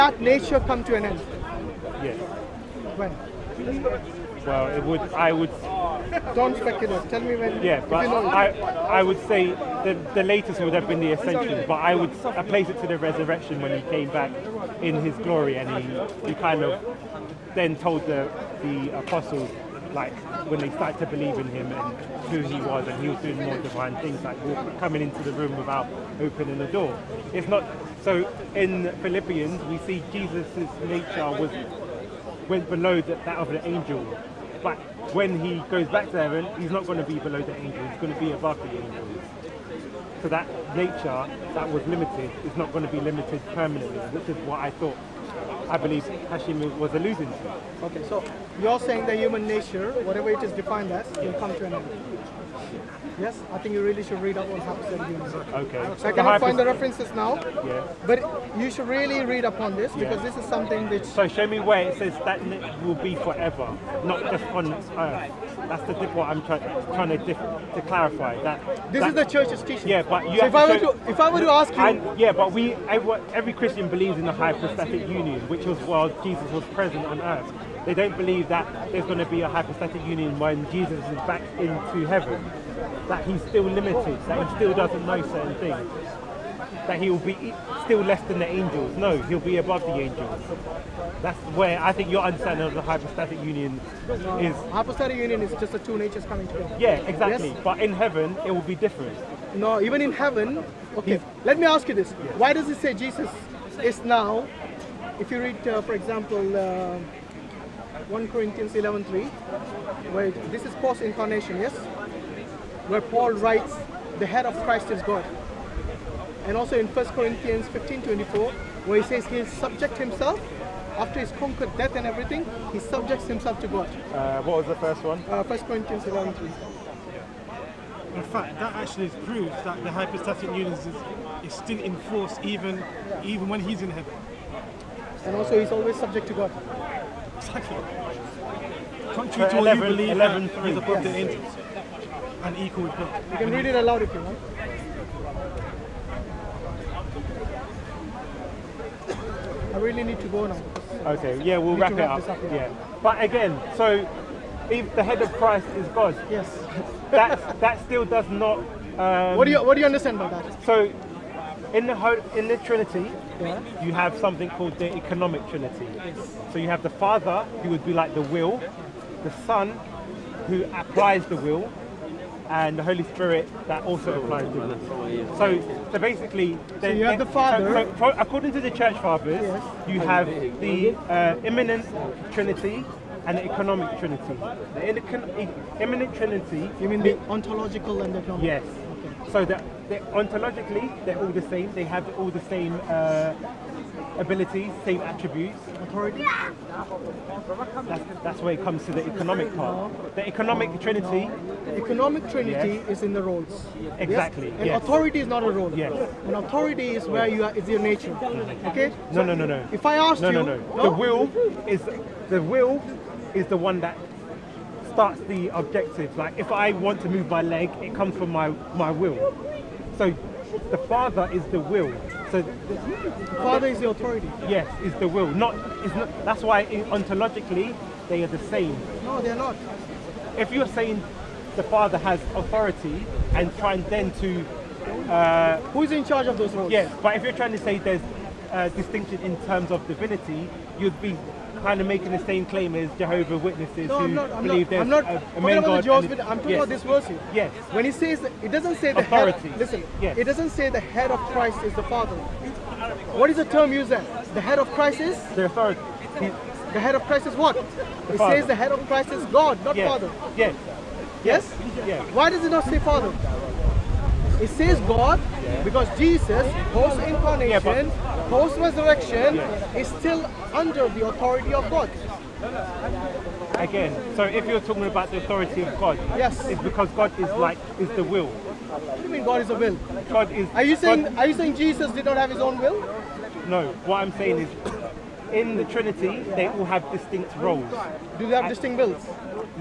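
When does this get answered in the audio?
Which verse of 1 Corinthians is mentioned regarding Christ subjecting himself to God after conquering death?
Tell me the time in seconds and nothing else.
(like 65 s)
116 s.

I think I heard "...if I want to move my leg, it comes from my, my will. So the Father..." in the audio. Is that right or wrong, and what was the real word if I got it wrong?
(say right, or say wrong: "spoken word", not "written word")
right.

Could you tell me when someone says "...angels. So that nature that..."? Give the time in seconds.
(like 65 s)
38 s.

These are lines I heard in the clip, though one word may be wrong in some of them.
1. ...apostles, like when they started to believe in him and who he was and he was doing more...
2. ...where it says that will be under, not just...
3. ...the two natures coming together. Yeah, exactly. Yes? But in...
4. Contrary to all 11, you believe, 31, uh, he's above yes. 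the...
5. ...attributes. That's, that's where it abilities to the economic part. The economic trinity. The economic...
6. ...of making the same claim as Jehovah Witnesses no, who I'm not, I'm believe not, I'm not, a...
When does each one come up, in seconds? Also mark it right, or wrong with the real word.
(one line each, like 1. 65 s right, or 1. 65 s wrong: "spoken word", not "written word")
1. 18 s right
2. 61 s wrong: "forever", not "under"
3. 95 s right
4. 139 s wrong: "11", not "31"
5. 195 s wrong: "comes", not "abilities"
6. 241 s right.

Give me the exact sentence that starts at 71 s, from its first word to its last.
I, yeah, but we every, every Christian believes in the hypostatic union, which was while Jesus was present on earth.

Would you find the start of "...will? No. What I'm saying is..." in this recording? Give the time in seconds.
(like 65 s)
282 s.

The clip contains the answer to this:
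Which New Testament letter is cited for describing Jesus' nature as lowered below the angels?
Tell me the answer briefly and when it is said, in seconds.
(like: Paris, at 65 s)
Philippians, at 29 s.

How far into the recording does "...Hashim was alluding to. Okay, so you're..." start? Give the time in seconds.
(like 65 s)
46 s.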